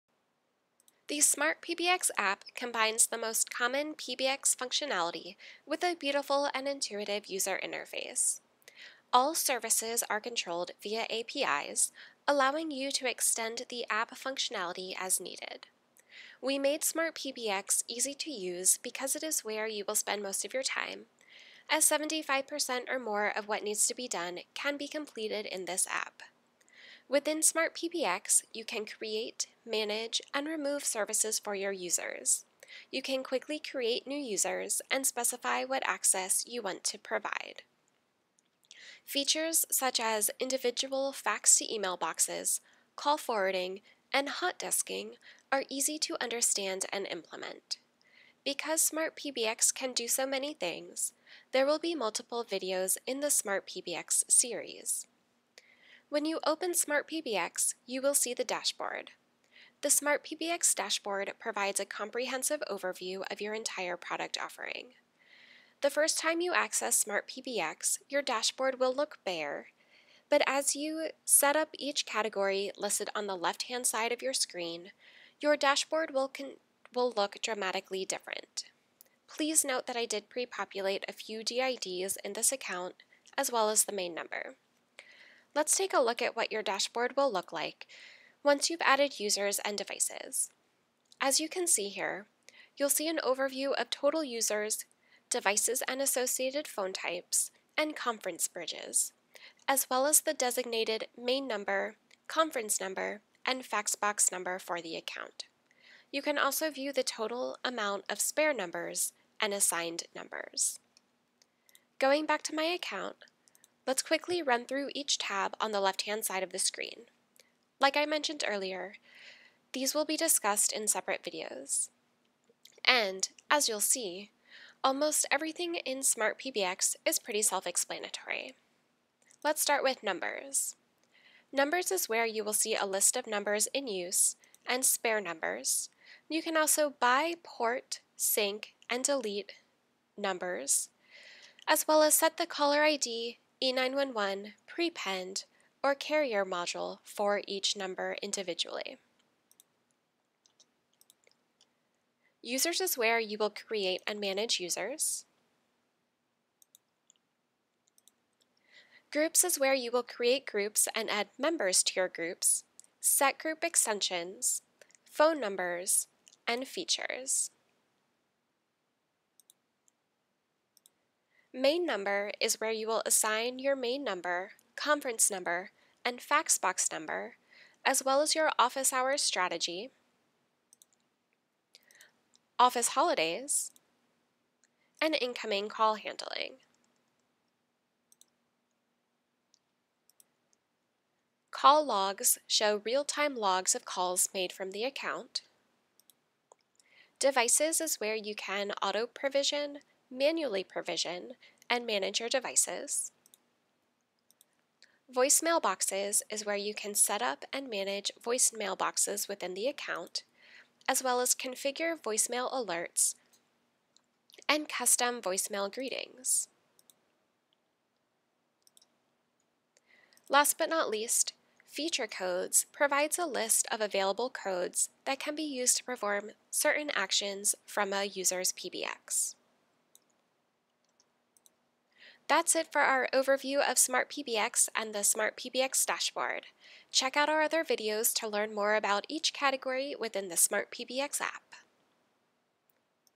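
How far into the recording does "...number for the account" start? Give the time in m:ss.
1:44.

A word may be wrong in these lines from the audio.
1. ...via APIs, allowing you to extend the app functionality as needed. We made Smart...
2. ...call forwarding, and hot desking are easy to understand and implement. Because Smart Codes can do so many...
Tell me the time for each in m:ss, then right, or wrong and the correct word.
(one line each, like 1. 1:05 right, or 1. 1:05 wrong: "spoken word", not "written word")
1. 0:10 right
2. 0:42 wrong: "PBX", not "Codes".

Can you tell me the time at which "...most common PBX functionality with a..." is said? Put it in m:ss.
0:03.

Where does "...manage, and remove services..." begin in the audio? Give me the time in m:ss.
0:29.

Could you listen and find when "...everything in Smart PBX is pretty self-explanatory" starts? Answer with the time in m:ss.
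2:05.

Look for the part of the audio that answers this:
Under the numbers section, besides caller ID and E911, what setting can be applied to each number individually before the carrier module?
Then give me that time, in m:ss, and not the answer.
2:24.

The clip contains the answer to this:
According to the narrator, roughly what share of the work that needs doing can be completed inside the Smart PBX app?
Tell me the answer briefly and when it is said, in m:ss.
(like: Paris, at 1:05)
75%, at 0:21.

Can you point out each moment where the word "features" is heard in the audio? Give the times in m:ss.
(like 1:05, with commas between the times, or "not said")
0:39, 2:46, 3:41.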